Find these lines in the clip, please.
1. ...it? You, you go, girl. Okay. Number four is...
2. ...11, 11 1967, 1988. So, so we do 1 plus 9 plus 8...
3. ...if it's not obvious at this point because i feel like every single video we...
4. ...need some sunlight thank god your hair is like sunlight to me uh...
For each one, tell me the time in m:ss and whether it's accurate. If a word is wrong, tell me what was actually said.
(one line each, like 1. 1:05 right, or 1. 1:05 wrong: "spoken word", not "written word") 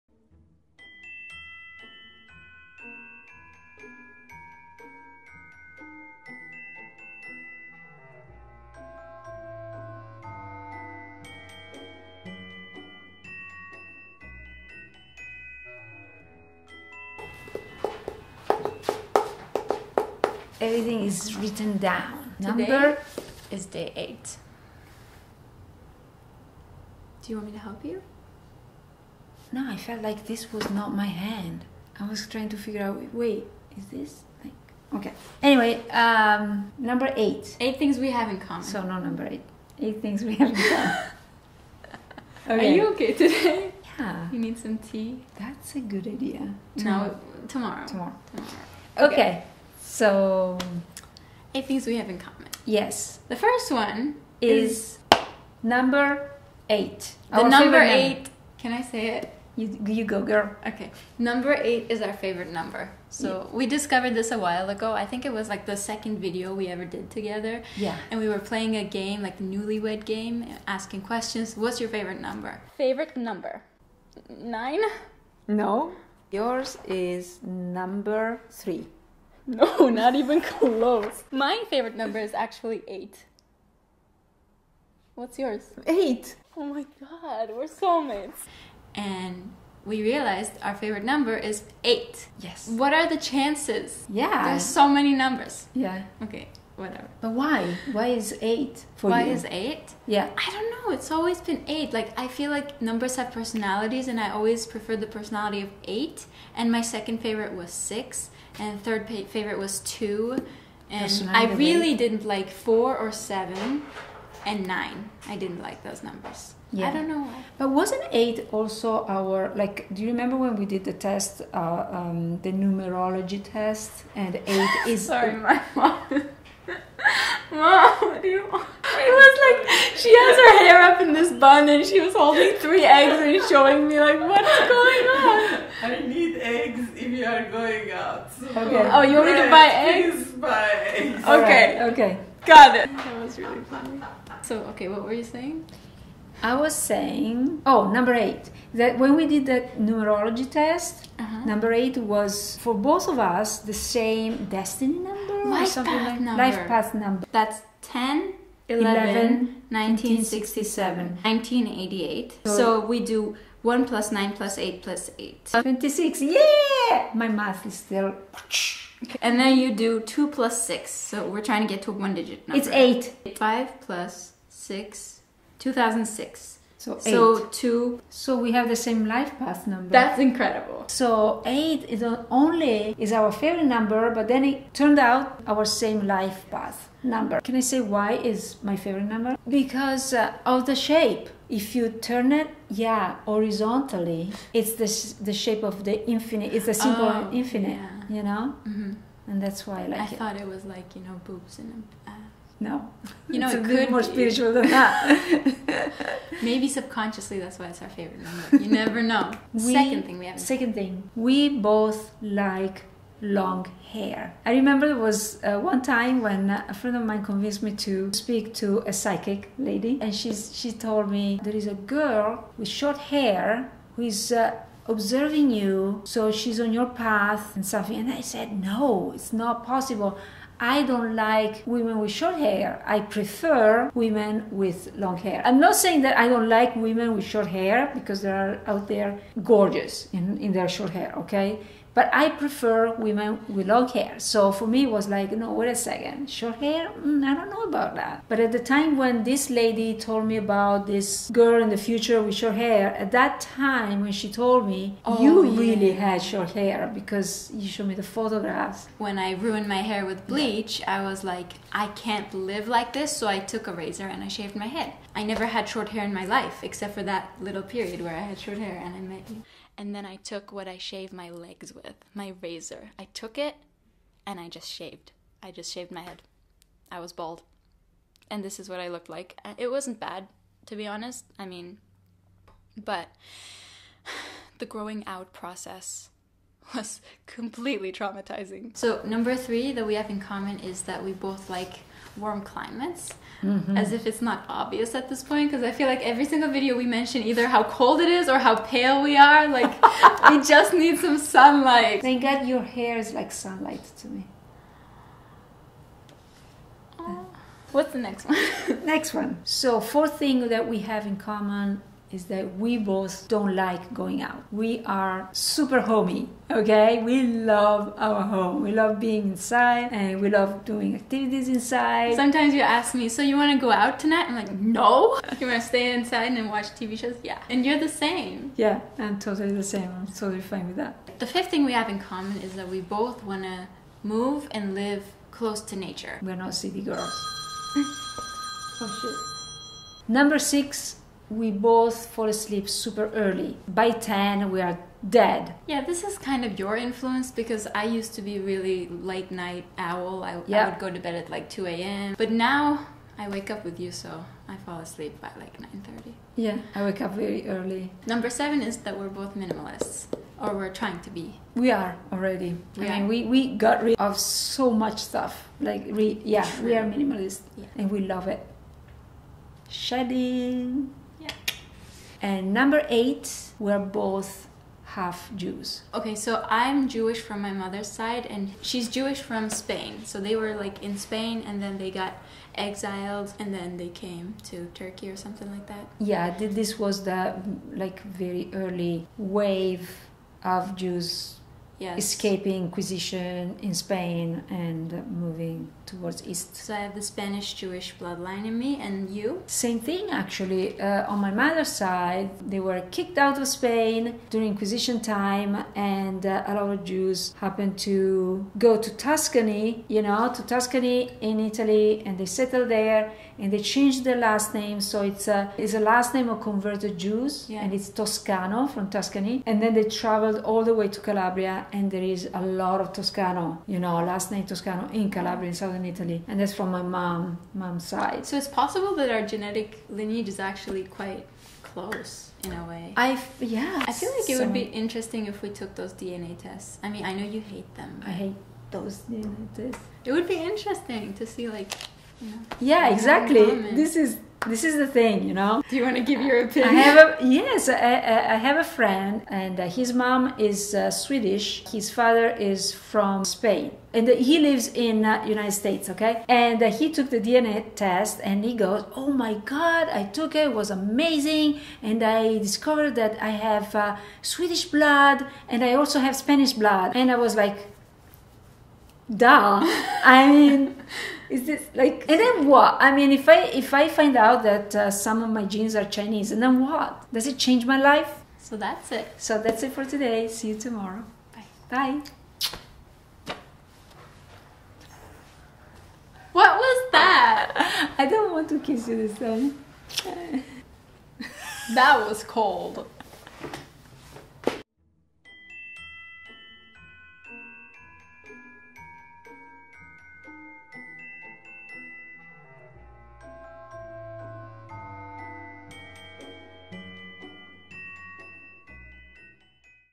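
1. 0:59 wrong: "eight", not "four"
2. 2:38 right
3. 4:53 right
4. 5:00 right.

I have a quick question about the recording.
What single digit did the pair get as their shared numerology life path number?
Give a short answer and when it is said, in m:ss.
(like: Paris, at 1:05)
8, at 2:52.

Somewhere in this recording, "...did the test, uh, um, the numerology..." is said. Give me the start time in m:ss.
2:00.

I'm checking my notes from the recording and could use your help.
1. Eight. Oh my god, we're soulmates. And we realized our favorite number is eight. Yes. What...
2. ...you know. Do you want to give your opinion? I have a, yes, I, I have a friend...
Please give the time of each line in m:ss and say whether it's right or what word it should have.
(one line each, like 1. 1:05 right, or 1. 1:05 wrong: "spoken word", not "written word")
1. 1:25 right
2. 7:25 right.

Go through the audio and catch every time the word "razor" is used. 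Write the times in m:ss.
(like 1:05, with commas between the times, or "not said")
4:23, 4:32.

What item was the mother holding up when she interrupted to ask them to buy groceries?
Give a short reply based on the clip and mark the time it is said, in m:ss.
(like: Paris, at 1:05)
three eggs, at 2:12.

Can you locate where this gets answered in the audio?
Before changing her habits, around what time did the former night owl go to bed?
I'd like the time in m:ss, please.
5:51.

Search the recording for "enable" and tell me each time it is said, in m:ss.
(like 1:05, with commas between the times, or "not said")
not said.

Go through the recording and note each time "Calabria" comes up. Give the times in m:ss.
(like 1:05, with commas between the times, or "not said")
7:01, 7:05.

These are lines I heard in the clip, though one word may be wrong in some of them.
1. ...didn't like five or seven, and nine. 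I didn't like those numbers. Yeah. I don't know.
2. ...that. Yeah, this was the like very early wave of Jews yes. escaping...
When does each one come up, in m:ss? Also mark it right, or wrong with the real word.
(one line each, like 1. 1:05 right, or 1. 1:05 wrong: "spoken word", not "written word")
1. 1:51 wrong: "four", not "five"
2. 6:25 right.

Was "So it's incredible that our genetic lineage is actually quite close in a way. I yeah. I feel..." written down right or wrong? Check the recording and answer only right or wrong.
wrong.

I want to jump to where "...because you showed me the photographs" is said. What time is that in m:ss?
4:16.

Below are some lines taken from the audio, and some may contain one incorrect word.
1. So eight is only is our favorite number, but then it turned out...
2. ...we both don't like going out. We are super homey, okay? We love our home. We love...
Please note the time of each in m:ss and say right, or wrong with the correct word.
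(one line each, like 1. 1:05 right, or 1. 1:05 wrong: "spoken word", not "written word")
1. 3:00 right
2. 5:12 right.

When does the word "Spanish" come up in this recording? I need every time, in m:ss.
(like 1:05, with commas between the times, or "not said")
6:37, 7:46.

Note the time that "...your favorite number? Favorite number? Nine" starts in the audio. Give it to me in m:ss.
1:11.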